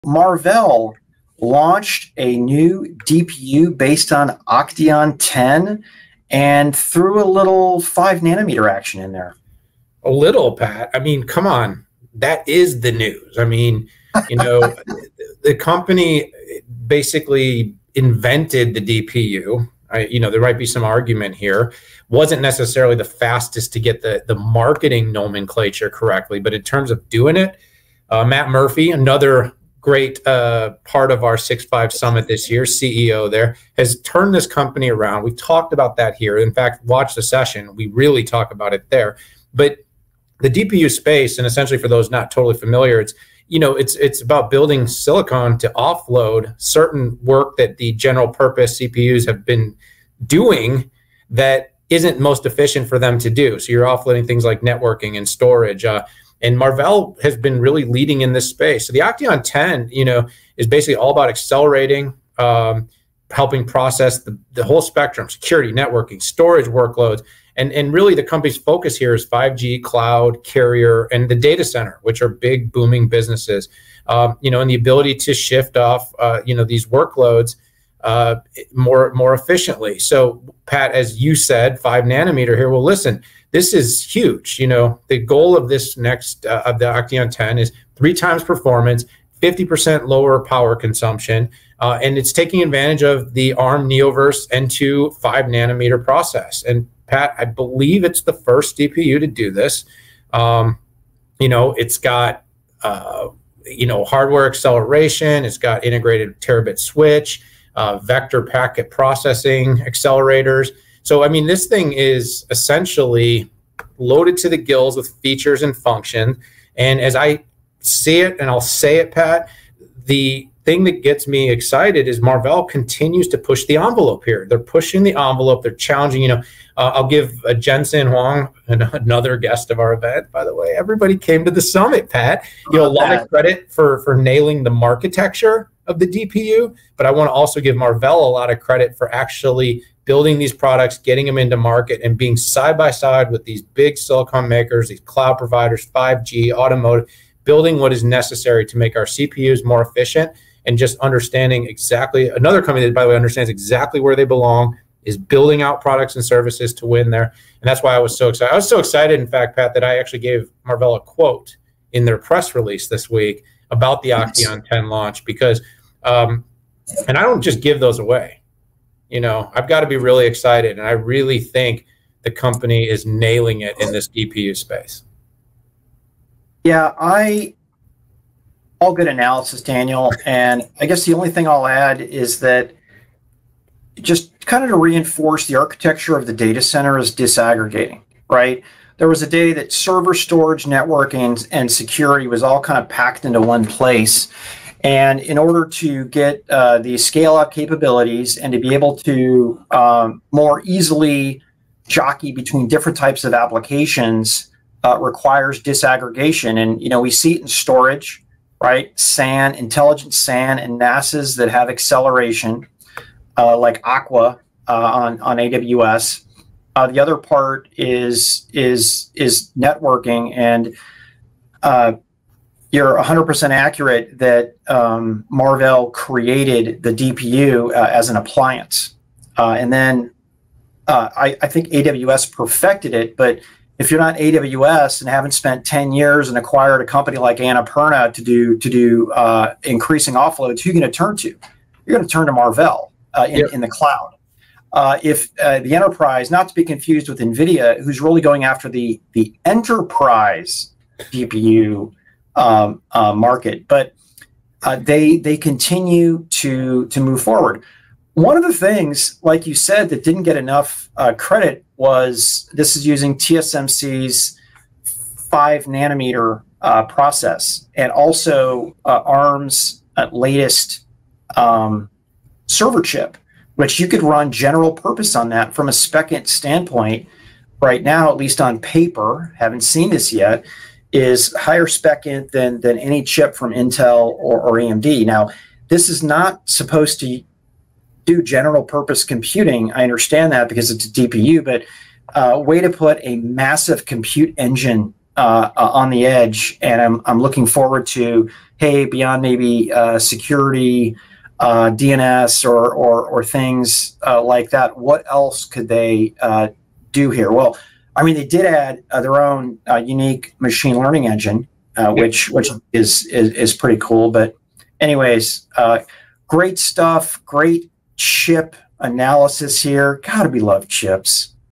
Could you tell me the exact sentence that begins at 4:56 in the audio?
And I'm, I'm looking forward to, hey, beyond maybe uh, security, uh, DNS or, or, or things uh, like that.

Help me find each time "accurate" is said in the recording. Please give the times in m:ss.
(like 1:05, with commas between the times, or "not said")
3:43.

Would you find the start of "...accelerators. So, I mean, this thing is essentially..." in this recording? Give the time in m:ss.
1:49.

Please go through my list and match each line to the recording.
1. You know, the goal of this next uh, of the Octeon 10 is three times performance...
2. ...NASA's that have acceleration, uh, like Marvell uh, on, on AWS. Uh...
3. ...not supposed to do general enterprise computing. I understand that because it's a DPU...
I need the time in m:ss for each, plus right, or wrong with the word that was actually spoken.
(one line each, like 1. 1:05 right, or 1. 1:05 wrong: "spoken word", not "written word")
1. 1:24 right
2. 3:30 wrong: "Aqua", not "Marvell"
3. 4:46 wrong: "purpose", not "enterprise".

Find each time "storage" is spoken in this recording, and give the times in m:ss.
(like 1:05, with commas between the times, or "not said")
0:55, 1:06, 3:10, 3:27.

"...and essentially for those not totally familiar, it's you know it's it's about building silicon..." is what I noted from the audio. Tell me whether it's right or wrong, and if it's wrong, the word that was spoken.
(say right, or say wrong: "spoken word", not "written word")
right.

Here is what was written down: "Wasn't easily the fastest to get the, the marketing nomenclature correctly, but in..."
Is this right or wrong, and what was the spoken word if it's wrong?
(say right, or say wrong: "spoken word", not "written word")
wrong: "necessarily", not "easily".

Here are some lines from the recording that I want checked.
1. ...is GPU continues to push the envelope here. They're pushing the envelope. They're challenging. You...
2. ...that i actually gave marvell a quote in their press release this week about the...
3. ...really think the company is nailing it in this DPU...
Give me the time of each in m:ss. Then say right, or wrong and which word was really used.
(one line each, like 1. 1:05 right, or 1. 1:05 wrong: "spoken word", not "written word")
1. 2:02 wrong: "Marvell", not "GPU"
2. 2:39 right
3. 2:50 right.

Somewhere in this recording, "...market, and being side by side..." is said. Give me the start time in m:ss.
2:21.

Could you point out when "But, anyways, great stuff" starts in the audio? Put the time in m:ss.
5:14.